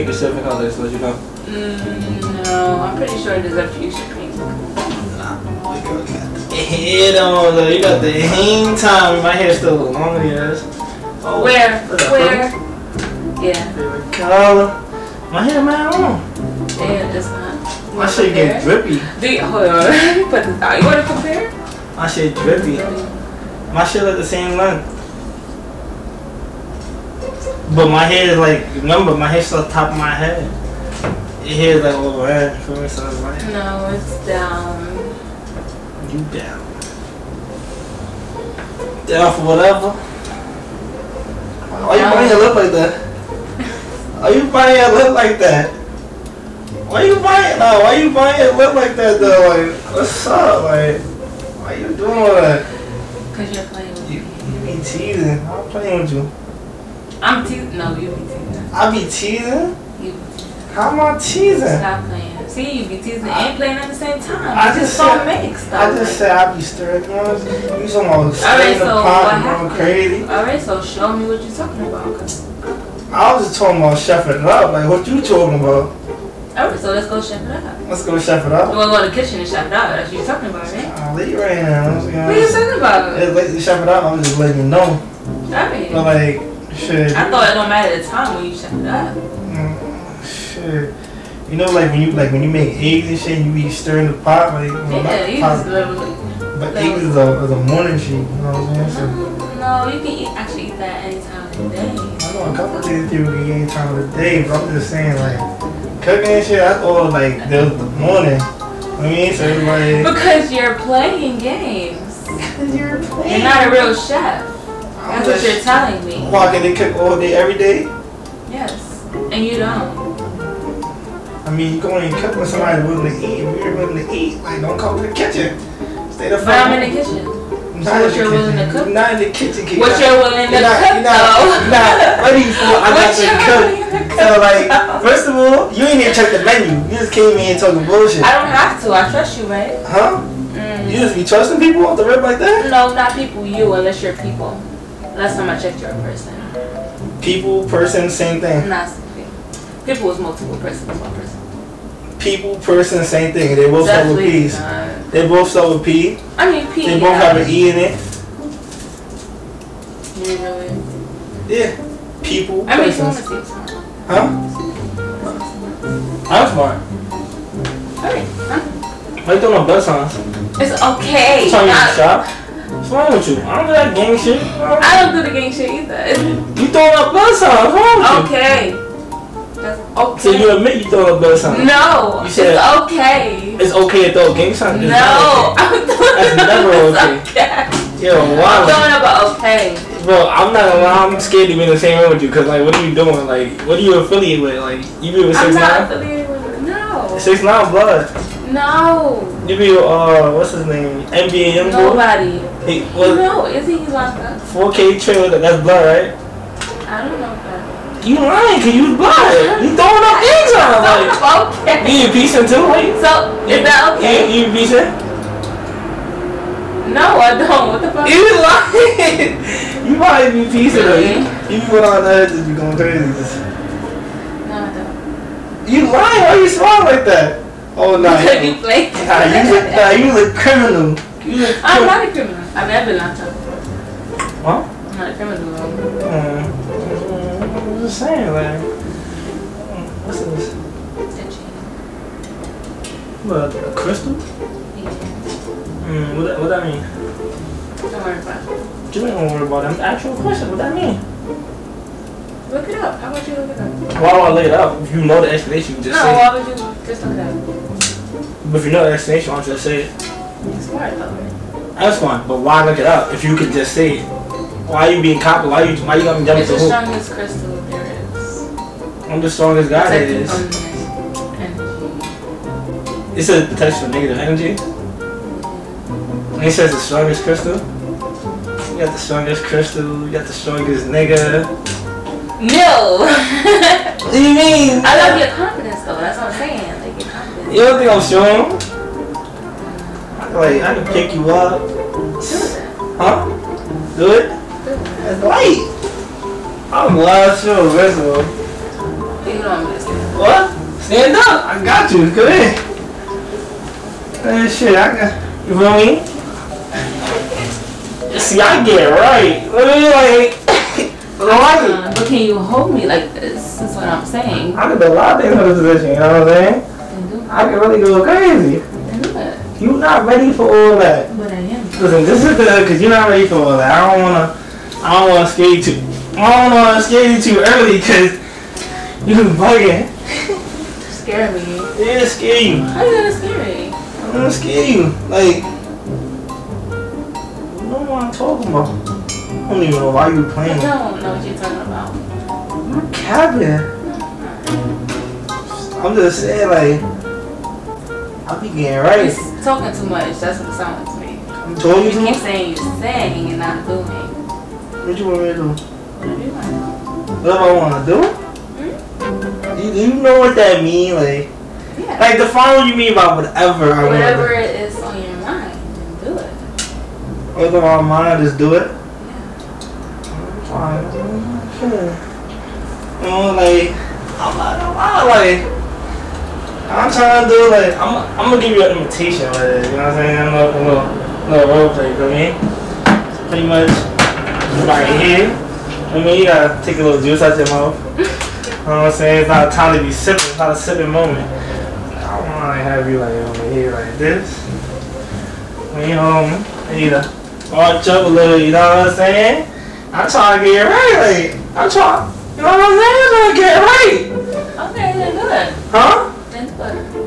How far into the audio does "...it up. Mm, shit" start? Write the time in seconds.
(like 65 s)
88 s.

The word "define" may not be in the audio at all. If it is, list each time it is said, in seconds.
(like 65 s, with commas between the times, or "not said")
362 s.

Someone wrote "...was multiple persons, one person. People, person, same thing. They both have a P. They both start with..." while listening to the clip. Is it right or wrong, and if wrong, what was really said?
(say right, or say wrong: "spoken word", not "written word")
right.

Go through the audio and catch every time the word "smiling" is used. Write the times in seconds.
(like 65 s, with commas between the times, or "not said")
226 s.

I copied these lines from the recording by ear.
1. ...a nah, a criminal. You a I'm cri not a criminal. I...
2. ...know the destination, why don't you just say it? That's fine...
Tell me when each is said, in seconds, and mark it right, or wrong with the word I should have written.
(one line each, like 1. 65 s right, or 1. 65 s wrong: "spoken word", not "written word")
1. 229 s right
2. 258 s right.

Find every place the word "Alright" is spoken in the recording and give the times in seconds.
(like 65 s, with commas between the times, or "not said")
70 s, 76 s.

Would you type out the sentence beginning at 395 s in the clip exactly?
When you home, to watch up a little.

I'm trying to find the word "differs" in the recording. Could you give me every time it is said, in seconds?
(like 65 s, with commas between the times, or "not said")
not said.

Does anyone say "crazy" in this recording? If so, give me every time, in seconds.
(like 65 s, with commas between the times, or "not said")
69 s, 222 s, 318 s.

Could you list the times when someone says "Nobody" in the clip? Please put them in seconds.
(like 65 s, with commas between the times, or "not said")
201 s.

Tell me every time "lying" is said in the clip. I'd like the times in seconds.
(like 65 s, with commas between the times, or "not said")
208 s, 218 s, 225 s.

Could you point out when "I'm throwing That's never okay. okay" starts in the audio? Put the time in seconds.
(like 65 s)
184 s.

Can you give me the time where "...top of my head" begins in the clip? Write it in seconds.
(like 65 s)
29 s.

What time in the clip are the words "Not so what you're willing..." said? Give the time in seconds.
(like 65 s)
127 s.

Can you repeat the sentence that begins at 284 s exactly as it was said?
I love your confidence though, that's what I'm saying.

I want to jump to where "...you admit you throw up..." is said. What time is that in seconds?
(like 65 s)
180 s.